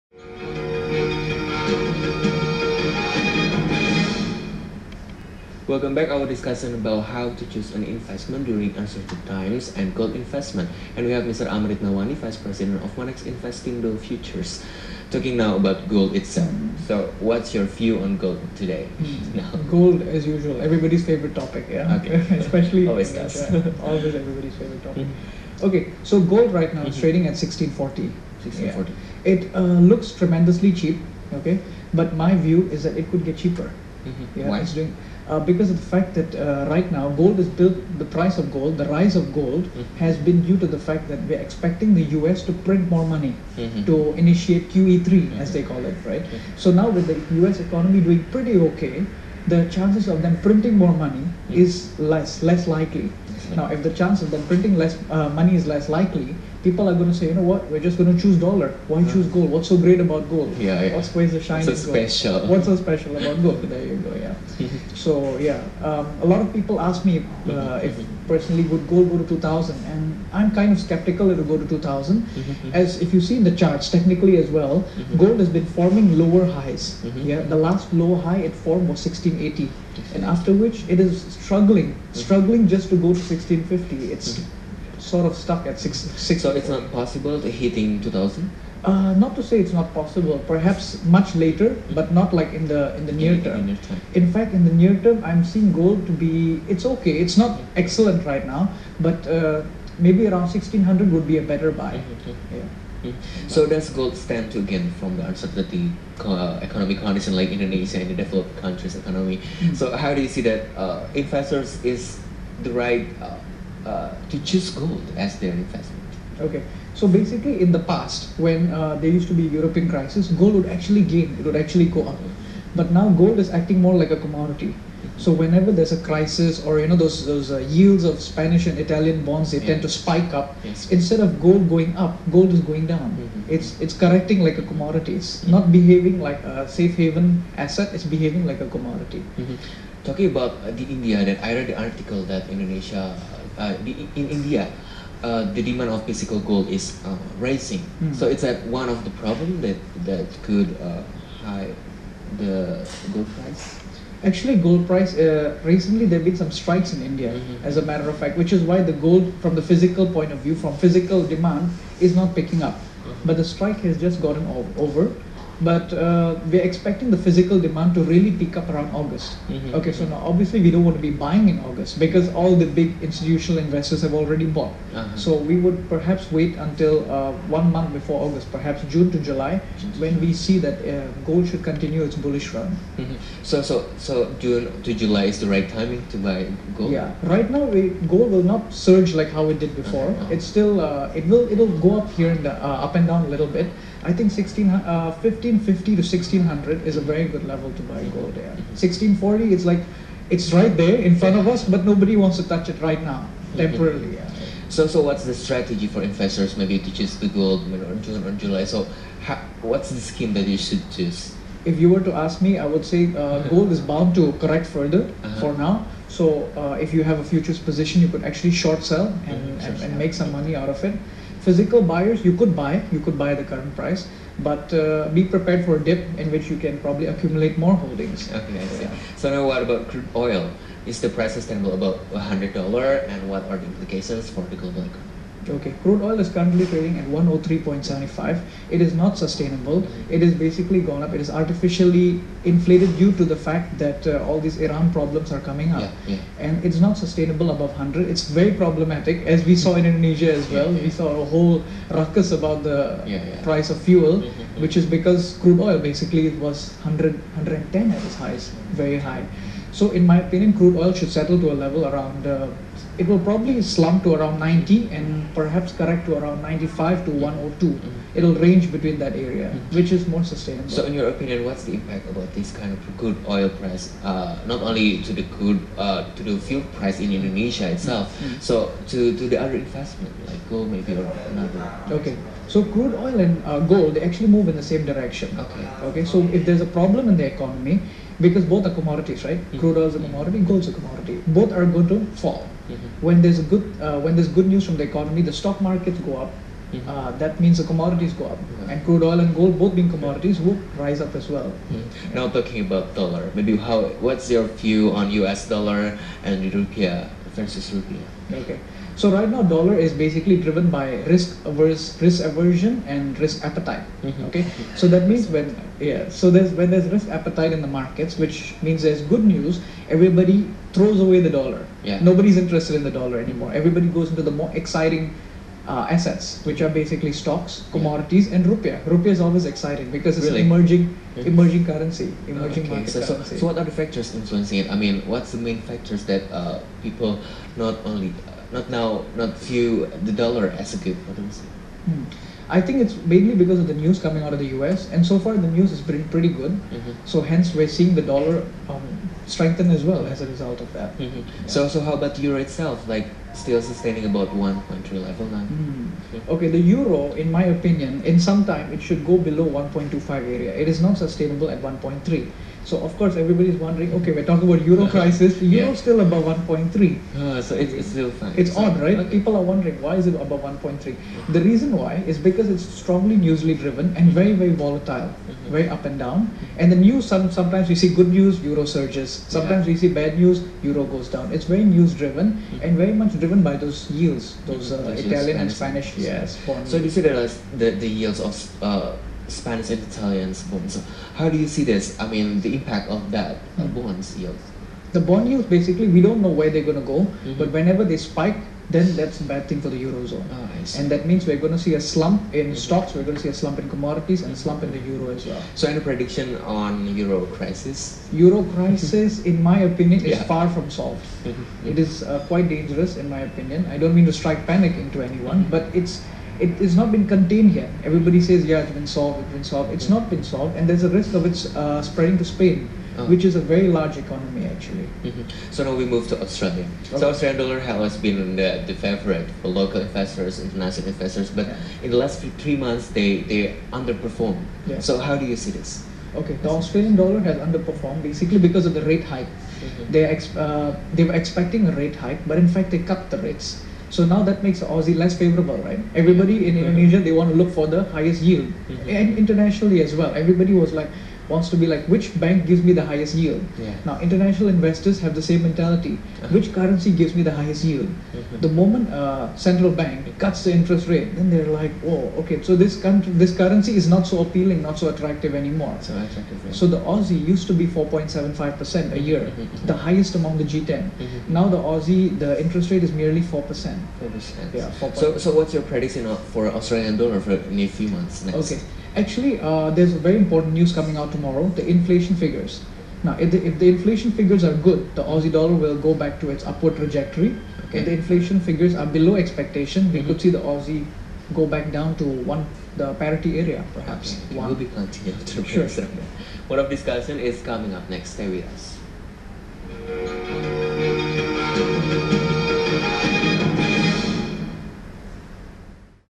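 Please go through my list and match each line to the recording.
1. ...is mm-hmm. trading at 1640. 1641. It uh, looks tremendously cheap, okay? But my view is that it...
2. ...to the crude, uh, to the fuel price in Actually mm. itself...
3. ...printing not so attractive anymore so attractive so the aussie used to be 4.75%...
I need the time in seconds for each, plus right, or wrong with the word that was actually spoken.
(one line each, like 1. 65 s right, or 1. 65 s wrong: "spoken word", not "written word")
1. 26 s wrong: "1640", not "1641"
2. 275 s wrong: "Indonesia", not "Actually"
3. 464 s wrong: "appealing", not "printing".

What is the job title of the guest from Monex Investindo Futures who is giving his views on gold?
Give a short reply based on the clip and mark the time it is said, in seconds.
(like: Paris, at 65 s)
Vice President, at 12 s.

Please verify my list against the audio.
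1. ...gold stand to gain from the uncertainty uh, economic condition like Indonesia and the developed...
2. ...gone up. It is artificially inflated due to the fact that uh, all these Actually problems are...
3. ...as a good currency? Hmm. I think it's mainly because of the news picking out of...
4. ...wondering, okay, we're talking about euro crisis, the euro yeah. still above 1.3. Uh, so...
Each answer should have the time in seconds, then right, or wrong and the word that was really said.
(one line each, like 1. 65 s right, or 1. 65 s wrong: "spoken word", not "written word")
1. 103 s right
2. 240 s wrong: "Iran", not "Actually"
3. 340 s wrong: "coming", not "picking"
4. 363 s right.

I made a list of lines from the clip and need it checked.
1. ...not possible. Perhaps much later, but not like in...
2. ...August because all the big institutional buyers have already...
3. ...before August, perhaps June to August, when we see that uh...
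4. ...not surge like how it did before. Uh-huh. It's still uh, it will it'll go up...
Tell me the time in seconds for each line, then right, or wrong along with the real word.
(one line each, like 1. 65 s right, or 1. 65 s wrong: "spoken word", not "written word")
1. 89 s right
2. 171 s wrong: "investors", not "buyers"
3. 177 s wrong: "July", not "August"
4. 188 s right.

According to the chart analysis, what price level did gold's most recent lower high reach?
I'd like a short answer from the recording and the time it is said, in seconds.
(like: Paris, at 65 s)
1680, at 79 s.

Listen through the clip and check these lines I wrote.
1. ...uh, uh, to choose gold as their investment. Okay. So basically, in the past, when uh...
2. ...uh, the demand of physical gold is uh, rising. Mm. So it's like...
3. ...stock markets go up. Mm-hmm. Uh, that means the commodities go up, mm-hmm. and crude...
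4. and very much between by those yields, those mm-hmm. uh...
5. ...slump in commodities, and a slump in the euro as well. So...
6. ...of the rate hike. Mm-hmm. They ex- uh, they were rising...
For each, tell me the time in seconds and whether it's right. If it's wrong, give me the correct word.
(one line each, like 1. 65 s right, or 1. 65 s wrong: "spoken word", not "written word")
1. 113 s right
2. 145 s right
3. 295 s right
4. 382 s wrong: "driven", not "between"
5. 403 s right
6. 438 s wrong: "expecting", not "rising".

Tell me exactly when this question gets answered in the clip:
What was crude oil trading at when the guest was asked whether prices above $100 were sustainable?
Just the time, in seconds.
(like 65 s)
237 s.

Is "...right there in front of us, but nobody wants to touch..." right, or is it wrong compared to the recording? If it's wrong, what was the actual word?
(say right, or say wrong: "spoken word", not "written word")
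right.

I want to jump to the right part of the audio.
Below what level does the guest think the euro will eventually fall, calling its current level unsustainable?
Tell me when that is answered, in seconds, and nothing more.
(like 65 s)
359 s.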